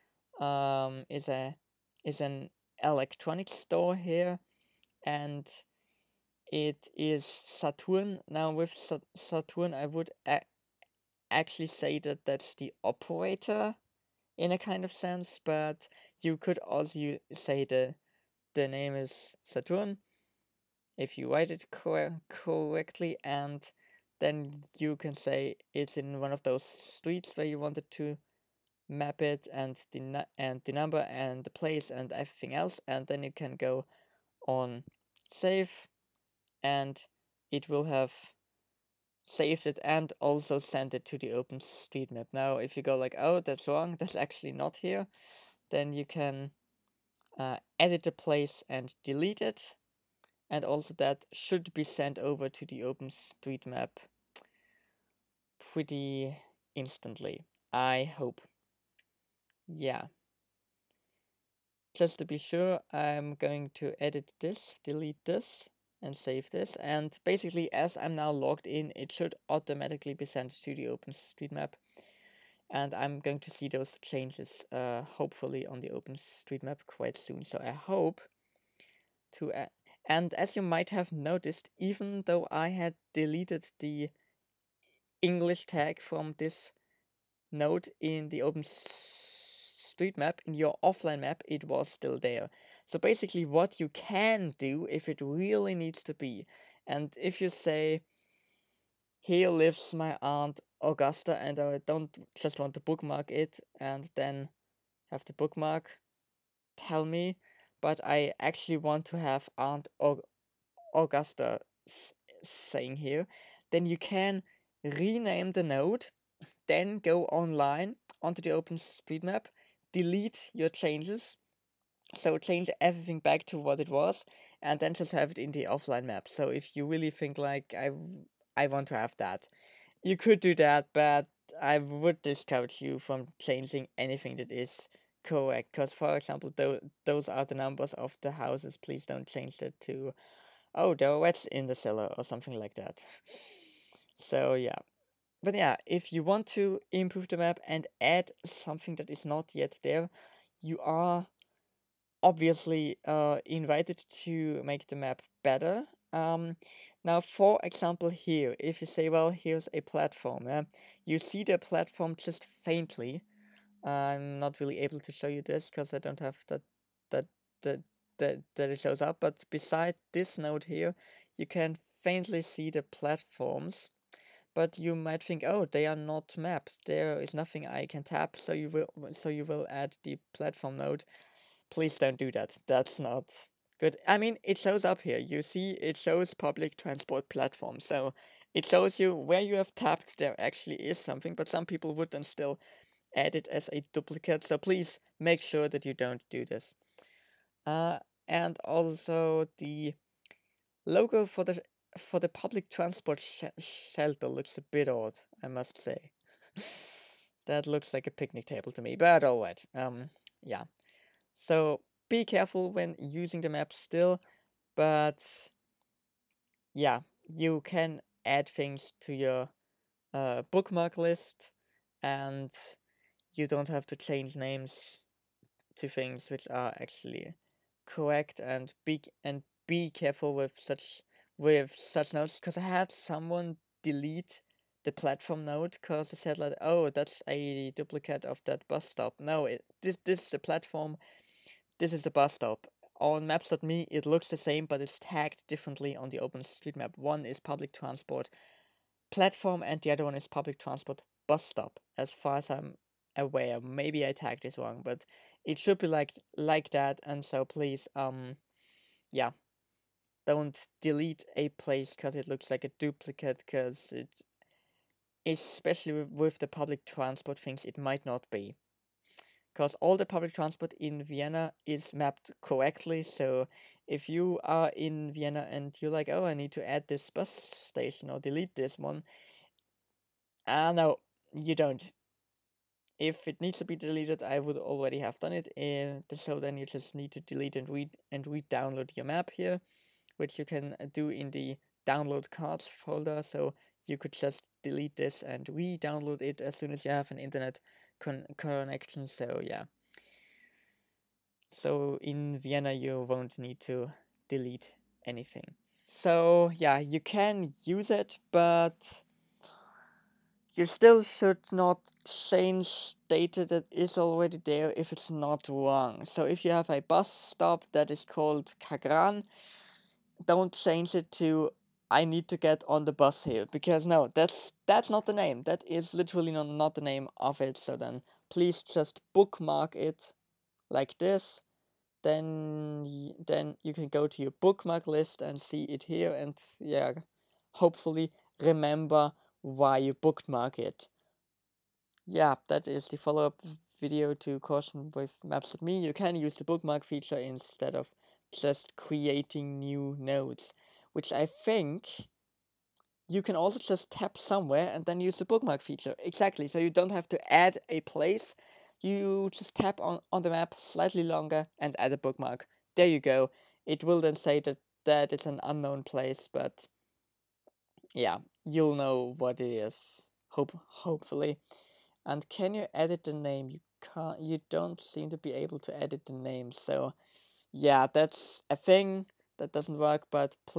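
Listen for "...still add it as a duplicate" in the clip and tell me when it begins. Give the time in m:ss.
3:12.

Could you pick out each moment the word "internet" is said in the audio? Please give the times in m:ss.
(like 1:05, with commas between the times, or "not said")
4:57.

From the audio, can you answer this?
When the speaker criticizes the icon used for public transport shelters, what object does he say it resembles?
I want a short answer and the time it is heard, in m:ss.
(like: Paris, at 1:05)
A picnic table, at 3:28.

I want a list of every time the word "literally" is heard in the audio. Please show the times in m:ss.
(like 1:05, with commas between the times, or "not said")
5:25.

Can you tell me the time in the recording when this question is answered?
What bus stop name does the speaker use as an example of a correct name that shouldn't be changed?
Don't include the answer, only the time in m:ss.
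5:18.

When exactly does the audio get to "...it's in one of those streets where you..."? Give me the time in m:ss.
0:25.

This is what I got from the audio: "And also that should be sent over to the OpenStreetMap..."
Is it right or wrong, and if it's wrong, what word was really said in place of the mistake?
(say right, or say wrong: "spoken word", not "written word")
right.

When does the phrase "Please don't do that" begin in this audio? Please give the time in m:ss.
3:01.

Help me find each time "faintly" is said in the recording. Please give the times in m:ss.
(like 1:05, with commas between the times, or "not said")
2:42, 2:52.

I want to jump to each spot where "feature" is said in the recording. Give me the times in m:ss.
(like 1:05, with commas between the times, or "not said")
5:46, 5:55.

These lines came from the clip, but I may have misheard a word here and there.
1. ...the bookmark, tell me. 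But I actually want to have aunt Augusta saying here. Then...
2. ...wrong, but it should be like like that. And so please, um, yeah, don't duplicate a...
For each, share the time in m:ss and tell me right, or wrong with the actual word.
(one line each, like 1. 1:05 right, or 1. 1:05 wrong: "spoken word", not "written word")
1. 1:45 right
2. 4:14 wrong: "delete", not "duplicate".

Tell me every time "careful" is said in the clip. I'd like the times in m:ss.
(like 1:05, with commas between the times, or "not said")
3:32, 3:49.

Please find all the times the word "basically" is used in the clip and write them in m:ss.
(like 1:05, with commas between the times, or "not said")
1:07, 1:32.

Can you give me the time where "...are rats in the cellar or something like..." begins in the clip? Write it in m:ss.
2:21.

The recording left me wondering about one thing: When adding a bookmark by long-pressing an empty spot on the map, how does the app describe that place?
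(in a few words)
Unknown place.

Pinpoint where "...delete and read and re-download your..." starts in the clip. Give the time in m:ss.
4:47.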